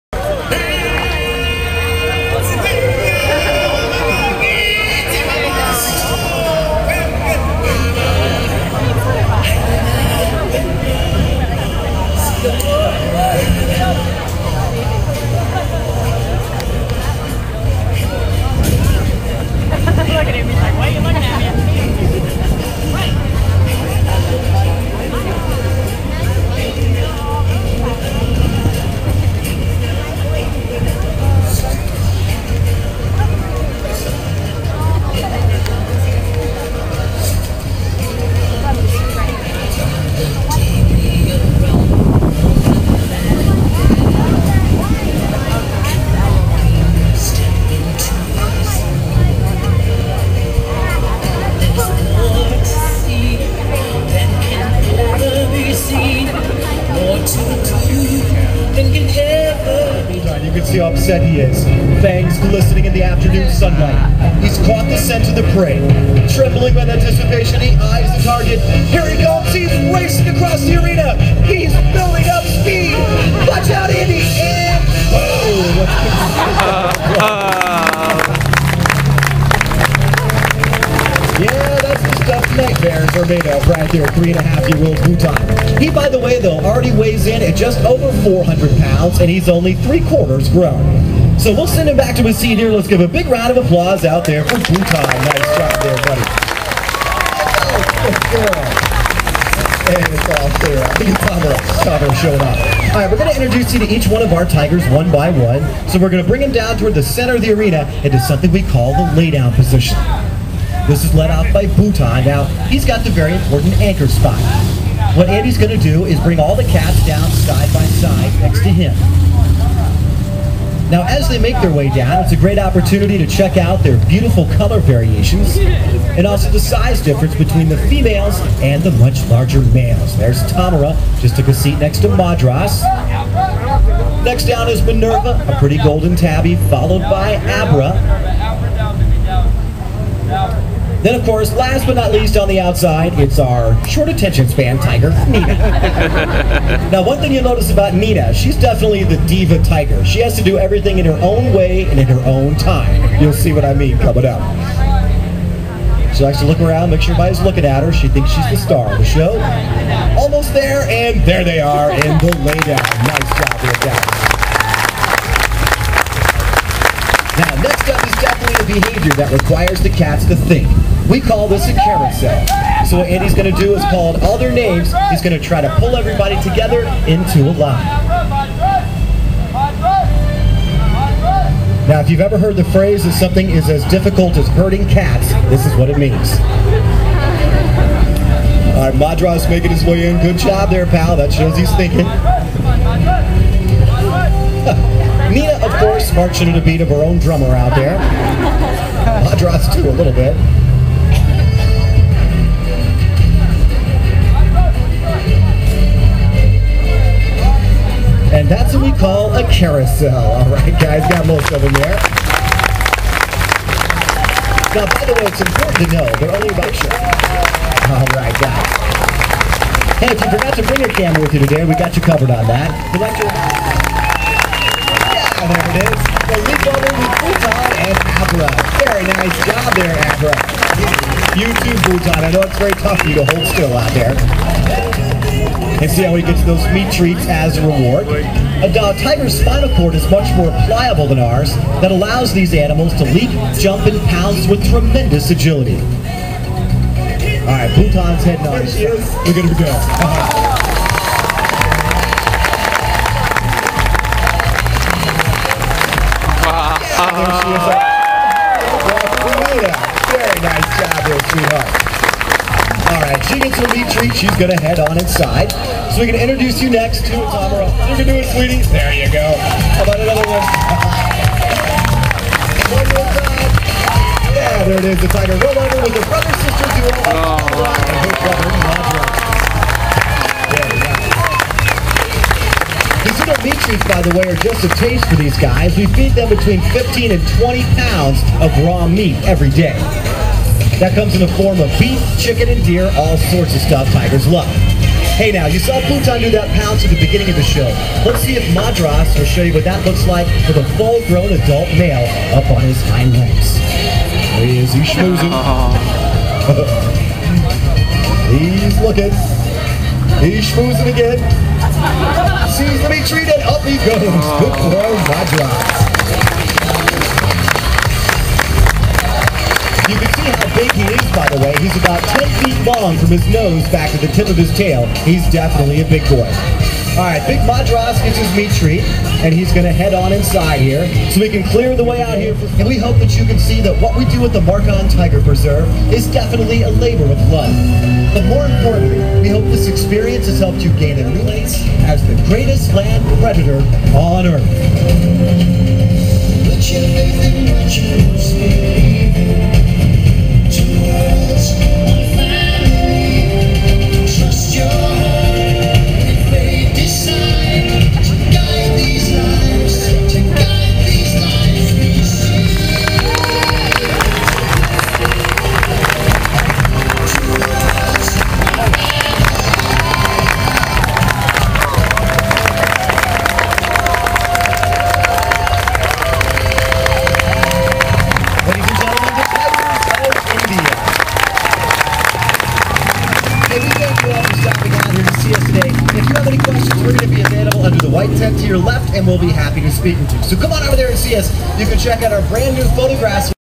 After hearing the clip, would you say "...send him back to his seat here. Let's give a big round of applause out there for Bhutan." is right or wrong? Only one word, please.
right.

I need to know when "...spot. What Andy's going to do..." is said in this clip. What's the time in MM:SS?
01:54.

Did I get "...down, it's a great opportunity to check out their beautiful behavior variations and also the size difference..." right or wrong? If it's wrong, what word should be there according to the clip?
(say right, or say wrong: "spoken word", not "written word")
wrong: "color", not "behavior".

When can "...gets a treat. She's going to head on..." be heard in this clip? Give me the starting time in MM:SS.
04:23.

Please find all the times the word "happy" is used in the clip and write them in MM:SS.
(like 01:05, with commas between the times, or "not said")
06:29.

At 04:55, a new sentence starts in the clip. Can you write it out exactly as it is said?
Hey now, you saw Bhutan do that pounce at the beginning of the show.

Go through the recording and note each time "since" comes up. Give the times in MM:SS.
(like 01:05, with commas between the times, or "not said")
not said.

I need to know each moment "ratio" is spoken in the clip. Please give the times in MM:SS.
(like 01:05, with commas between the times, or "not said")
not said.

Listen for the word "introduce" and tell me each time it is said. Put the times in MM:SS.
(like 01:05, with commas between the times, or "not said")
01:43, 04:26.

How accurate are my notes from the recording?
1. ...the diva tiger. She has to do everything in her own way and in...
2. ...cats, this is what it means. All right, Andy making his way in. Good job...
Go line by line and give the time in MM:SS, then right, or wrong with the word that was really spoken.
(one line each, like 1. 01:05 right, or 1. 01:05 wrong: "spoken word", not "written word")
1. 02:29 right
2. 03:04 wrong: "Madras", not "Andy".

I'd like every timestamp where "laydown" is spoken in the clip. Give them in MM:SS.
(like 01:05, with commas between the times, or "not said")
01:49, 02:42.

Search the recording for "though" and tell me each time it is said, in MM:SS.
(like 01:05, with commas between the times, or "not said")
01:26.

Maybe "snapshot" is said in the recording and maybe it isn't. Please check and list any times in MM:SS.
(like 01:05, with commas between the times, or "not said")
not said.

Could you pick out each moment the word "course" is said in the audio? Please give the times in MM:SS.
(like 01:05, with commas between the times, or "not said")
02:21, 03:15.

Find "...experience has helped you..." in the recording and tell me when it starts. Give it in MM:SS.
05:39.